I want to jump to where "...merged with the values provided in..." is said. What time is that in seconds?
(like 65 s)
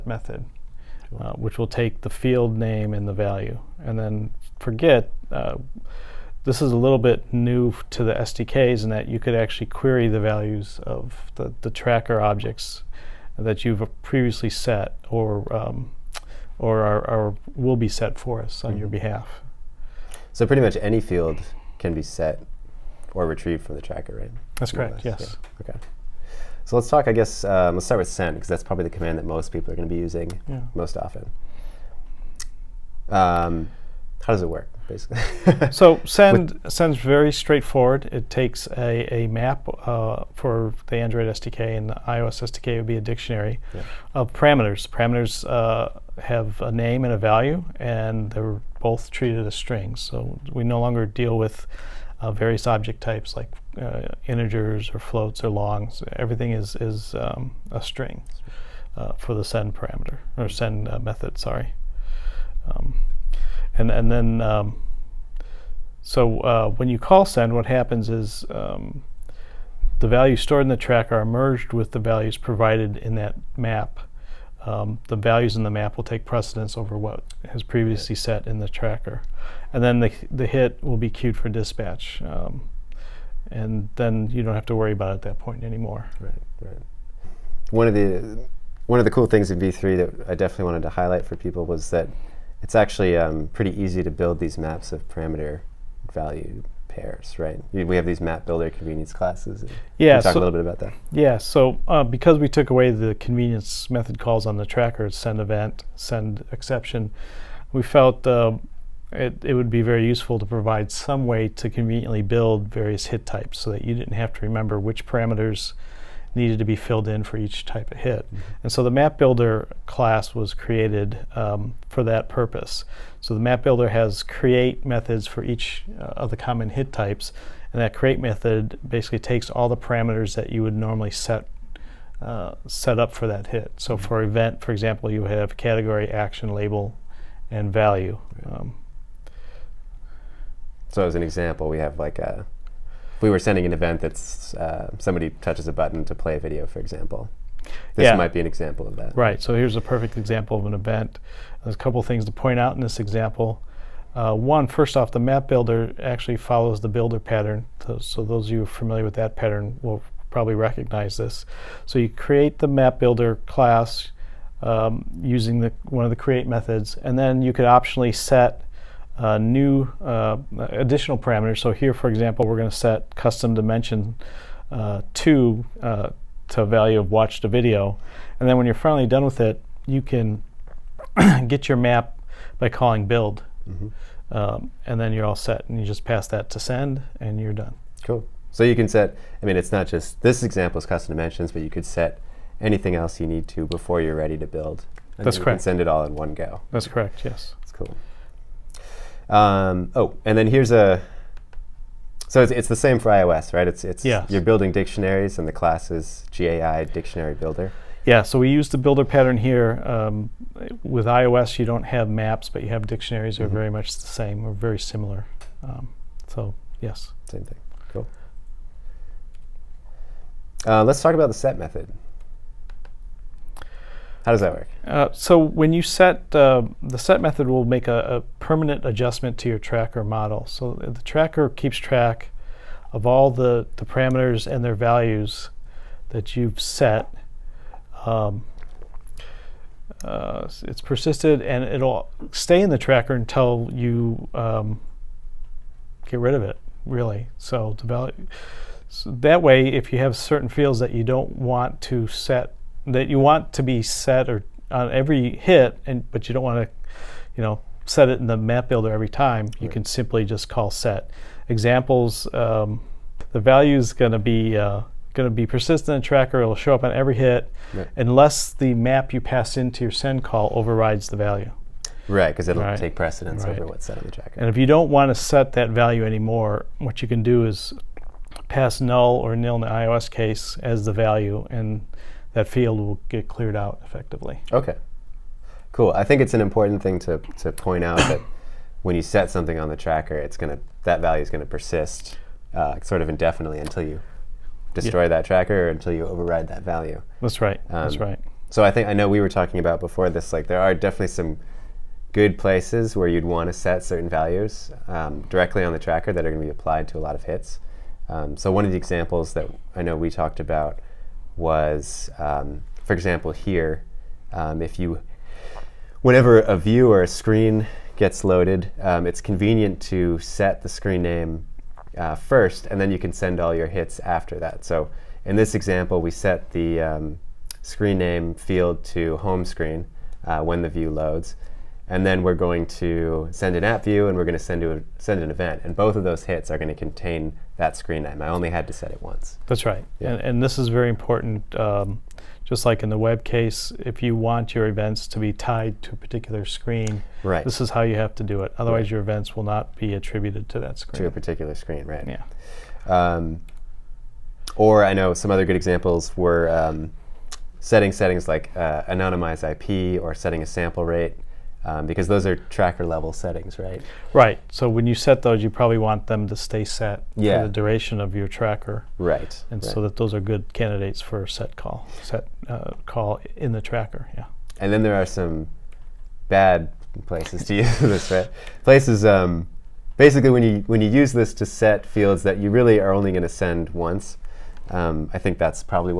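71 s.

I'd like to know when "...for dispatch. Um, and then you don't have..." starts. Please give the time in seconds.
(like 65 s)
81 s.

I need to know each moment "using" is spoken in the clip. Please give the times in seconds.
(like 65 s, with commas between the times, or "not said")
30 s, 165 s.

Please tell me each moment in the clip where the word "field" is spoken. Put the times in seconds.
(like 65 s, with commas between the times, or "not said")
2 s, 21 s, 250 s, 282 s, 328 s, 381 s.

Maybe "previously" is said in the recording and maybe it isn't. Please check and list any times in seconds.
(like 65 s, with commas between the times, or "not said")
14 s, 77 s.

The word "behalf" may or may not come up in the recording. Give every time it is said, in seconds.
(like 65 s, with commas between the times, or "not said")
19 s.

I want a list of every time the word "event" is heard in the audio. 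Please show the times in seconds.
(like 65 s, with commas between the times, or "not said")
105 s, 134 s, 143 s, 150 s, 335 s, 344 s, 349 s.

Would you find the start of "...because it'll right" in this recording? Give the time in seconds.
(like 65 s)
272 s.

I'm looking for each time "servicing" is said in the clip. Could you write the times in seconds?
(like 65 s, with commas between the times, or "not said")
not said.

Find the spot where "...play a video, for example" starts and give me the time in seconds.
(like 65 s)
146 s.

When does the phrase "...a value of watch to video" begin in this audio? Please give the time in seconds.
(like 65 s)
176 s.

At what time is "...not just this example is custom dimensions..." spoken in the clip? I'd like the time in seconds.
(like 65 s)
189 s.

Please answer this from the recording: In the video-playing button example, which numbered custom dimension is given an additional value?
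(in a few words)
2.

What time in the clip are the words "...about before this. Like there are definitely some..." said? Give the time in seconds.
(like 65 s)
299 s.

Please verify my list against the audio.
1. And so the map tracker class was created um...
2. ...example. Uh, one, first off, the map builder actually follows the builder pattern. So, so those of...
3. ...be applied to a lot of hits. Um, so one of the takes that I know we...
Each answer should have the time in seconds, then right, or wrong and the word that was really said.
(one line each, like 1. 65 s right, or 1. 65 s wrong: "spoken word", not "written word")
1. 118 s wrong: "builder", not "tracker"
2. 152 s right
3. 306 s wrong: "examples", not "takes".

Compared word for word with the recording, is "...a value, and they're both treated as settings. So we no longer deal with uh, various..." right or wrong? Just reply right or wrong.
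wrong.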